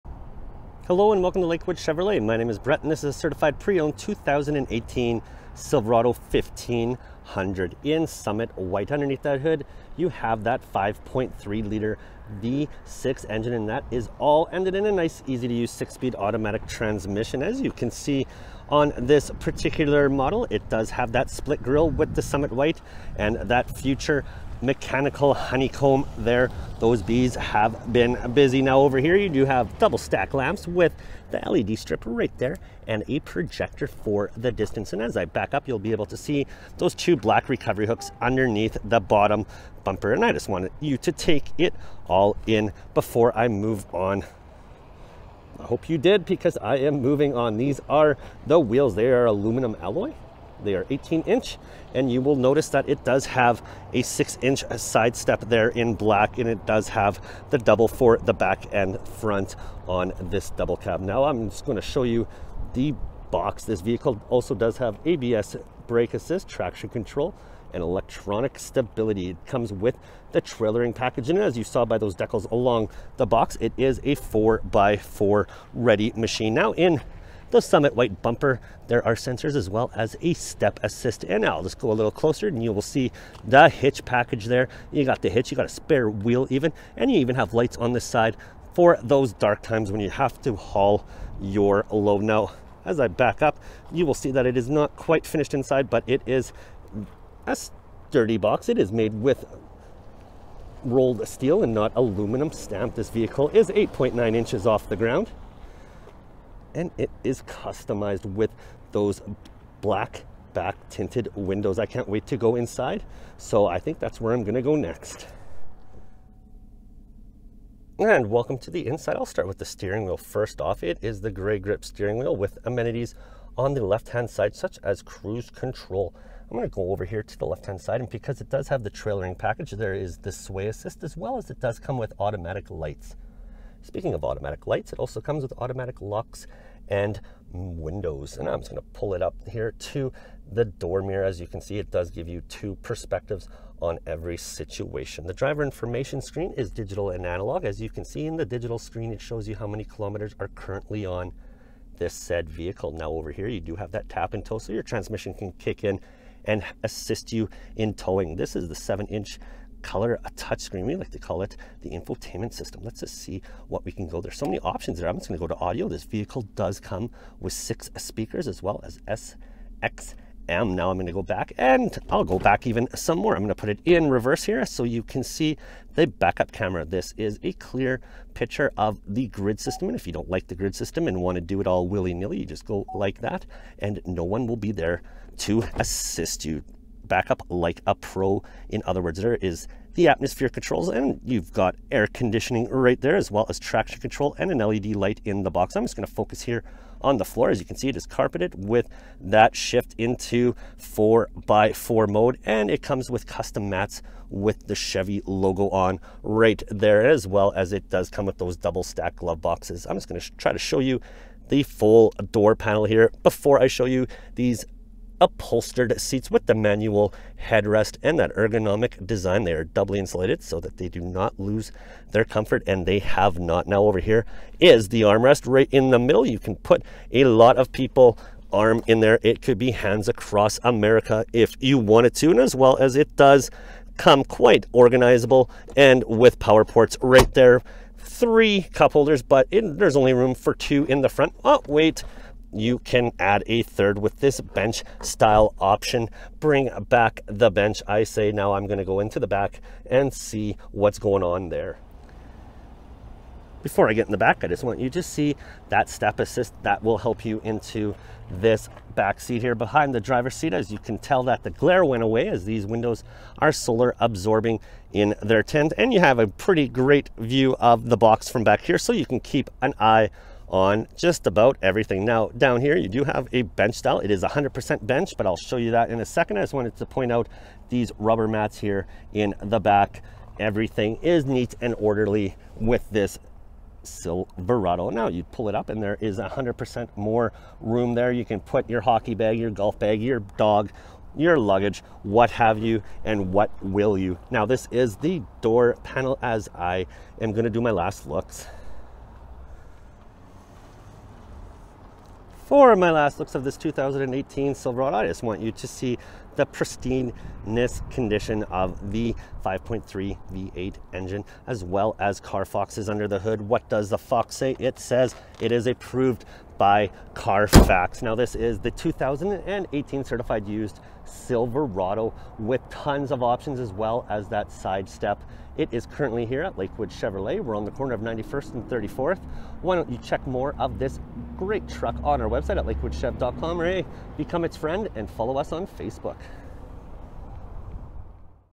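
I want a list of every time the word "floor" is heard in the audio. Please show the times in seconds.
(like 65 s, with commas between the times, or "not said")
197 s.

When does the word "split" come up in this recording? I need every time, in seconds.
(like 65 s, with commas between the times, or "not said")
21 s.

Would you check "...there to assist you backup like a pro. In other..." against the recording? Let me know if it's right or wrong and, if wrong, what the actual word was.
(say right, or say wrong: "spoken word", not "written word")
right.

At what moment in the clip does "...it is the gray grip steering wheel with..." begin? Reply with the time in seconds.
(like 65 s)
120 s.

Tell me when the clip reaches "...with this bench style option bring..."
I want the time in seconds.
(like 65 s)
243 s.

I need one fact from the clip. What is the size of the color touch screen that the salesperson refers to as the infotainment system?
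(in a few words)
7 inch.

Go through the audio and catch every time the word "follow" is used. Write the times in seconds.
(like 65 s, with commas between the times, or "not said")
335 s.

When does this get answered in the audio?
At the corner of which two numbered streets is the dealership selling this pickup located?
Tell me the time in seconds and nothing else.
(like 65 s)
328 s.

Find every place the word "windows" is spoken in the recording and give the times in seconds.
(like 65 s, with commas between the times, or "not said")
111 s, 137 s, 262 s.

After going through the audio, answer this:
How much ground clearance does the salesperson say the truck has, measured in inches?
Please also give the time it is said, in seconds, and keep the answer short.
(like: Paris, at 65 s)
8.9 inches, at 103 s.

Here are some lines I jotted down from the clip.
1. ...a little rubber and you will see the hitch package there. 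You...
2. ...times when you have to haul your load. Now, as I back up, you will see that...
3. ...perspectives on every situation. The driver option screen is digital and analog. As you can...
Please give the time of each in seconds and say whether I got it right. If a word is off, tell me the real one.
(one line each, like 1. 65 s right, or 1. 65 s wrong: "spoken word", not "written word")
1. 81 s wrong: "closer", not "rubber"
2. 89 s right
3. 142 s wrong: "information", not "option".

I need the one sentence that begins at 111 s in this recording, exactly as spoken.
I can't wait to go inside.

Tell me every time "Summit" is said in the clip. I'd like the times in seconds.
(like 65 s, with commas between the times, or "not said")
8 s, 22 s, 77 s.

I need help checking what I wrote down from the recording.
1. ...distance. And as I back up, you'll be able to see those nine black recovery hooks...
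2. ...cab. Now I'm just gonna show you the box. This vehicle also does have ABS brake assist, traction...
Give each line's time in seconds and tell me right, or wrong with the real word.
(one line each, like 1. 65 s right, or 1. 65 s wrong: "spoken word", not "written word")
1. 34 s wrong: "two", not "nine"
2. 60 s right.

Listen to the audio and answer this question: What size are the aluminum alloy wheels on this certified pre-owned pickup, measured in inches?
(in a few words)
18 inch.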